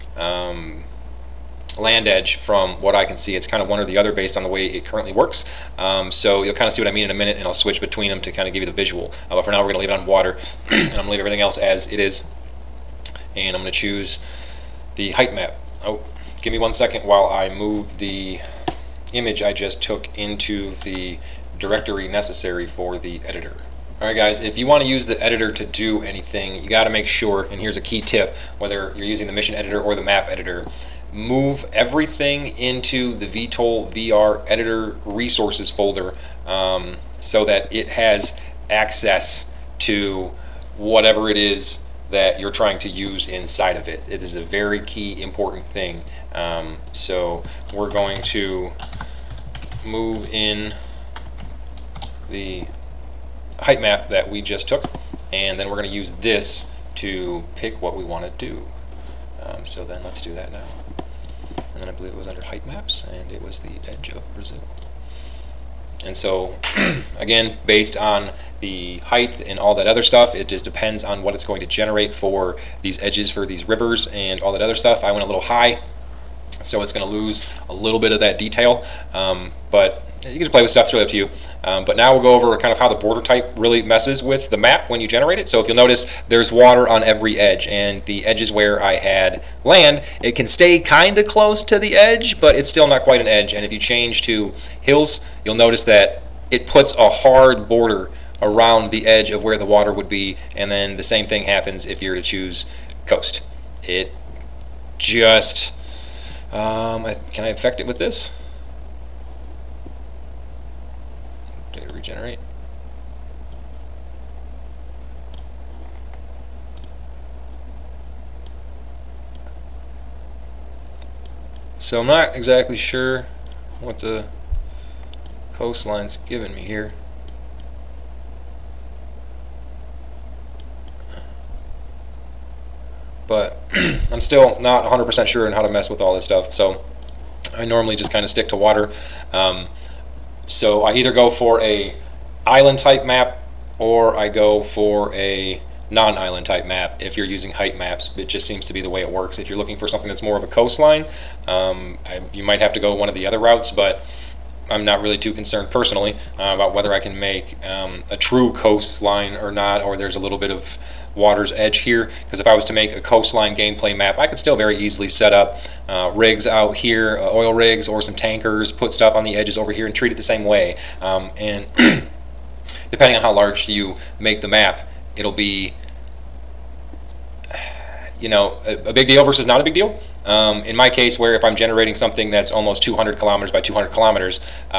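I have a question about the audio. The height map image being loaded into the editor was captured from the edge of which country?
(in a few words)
Brazil.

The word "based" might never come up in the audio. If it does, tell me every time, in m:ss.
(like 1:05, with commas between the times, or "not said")
0:04, 1:07.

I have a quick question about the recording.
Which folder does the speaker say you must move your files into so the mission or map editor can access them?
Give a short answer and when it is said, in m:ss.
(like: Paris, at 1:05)
VTOL VR editor resources folder, at 0:33.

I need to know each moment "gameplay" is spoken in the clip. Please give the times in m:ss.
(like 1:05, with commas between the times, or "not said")
2:43.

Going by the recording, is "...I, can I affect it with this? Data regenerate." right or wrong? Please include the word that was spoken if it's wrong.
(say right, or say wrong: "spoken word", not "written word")
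right.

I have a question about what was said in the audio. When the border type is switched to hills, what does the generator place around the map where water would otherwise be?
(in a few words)
A hard border.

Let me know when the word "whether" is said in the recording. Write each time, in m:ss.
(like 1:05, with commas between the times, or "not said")
0:28, 2:36.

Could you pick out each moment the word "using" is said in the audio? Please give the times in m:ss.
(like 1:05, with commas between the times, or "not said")
0:29, 2:27.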